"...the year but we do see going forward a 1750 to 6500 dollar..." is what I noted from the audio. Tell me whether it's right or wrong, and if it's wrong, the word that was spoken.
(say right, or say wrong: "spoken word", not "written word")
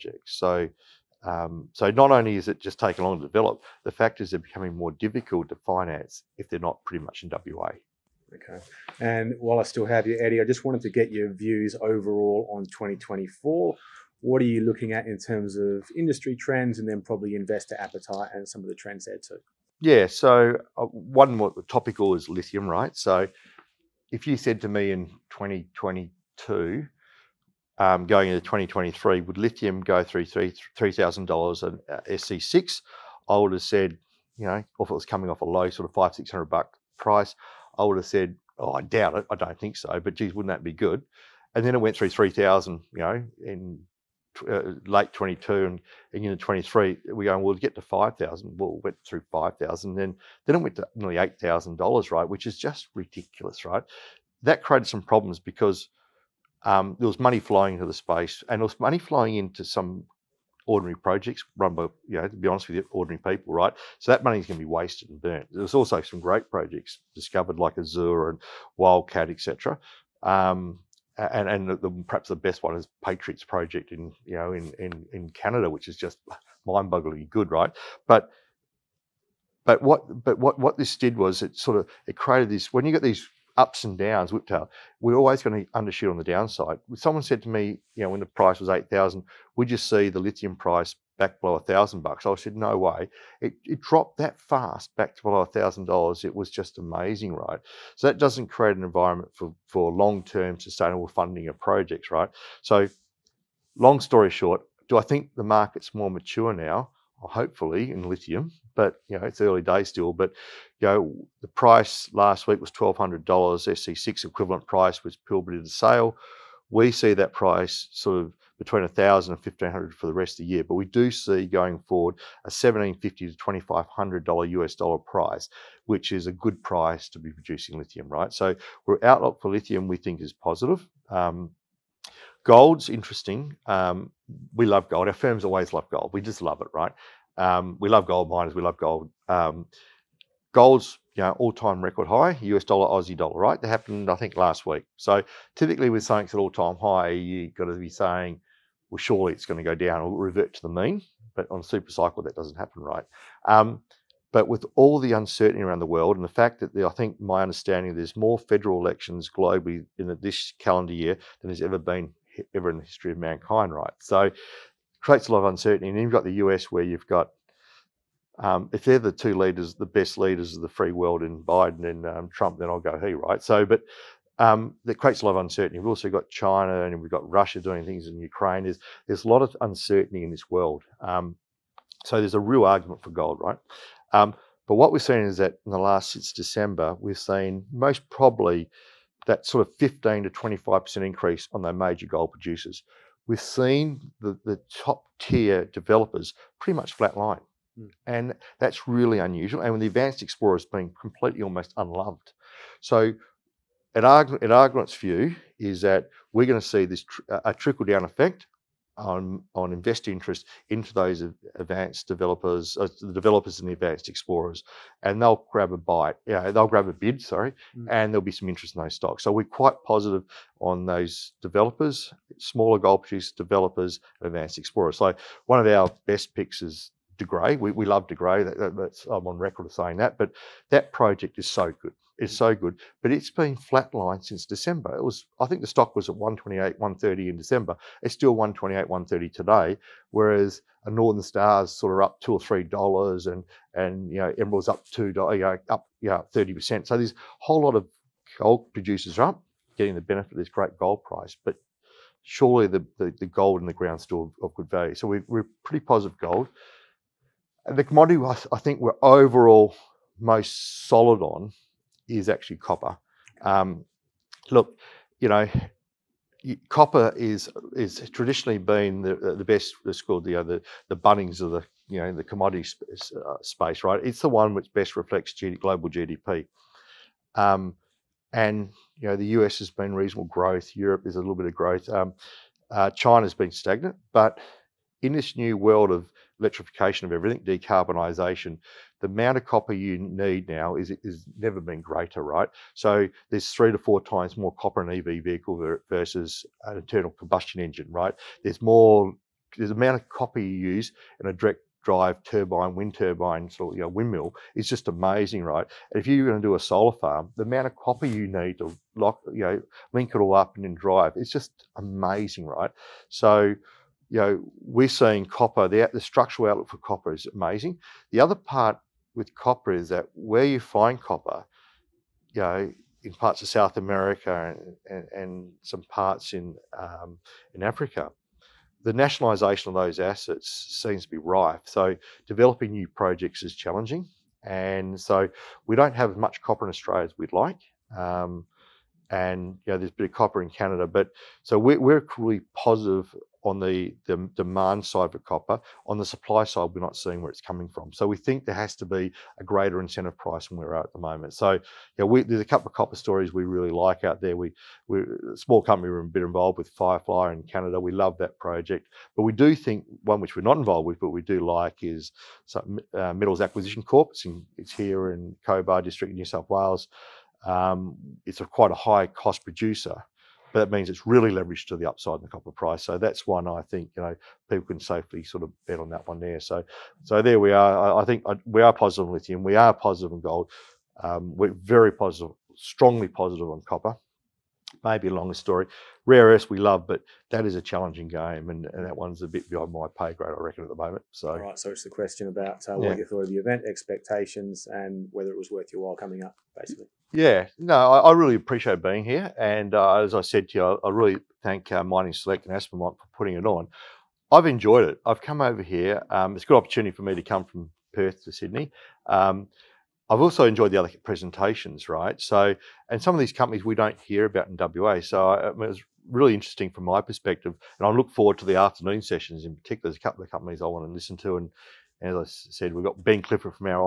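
wrong: "2500", not "6500".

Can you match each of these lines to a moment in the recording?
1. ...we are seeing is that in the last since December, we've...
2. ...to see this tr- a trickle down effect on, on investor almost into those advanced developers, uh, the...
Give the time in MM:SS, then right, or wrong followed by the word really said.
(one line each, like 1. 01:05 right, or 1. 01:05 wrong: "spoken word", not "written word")
1. 03:04 right
2. 03:26 wrong: "interest", not "almost".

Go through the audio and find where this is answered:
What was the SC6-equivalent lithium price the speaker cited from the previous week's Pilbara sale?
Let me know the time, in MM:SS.
01:52.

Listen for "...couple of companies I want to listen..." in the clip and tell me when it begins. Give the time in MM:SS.
07:00.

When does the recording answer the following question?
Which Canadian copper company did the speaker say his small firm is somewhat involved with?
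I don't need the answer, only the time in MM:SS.
05:56.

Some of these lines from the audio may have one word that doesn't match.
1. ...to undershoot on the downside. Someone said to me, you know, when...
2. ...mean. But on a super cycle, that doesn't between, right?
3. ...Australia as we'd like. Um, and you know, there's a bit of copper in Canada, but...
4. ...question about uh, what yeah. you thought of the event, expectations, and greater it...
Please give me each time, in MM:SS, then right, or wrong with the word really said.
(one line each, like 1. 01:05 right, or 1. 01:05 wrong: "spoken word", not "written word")
1. 01:25 right
2. 02:30 wrong: "happen", not "between"
3. 05:36 right
4. 06:31 wrong: "whether", not "greater".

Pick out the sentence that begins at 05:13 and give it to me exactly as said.
So you know, we're seeing copper, the, the structural outlook for copper is amazing.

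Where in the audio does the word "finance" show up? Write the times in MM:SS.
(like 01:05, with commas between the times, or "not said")
00:05.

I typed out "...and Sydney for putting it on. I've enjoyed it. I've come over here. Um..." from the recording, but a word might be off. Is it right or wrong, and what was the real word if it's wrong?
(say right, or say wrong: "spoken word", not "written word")
wrong: "Aspermont", not "Sydney".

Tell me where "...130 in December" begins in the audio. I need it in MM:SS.
03:56.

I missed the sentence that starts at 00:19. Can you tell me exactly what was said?
Yeah, so uh, one more topical is lithium, right?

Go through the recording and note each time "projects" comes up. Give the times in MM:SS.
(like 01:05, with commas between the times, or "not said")
01:00, 01:06, 01:13, 01:41, 03:50, 05:32, 05:58.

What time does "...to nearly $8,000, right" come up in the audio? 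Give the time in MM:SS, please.
00:50.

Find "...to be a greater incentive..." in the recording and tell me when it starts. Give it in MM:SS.
05:48.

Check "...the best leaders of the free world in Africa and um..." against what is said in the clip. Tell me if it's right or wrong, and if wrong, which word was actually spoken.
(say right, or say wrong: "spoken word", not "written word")
wrong: "Biden", not "Africa".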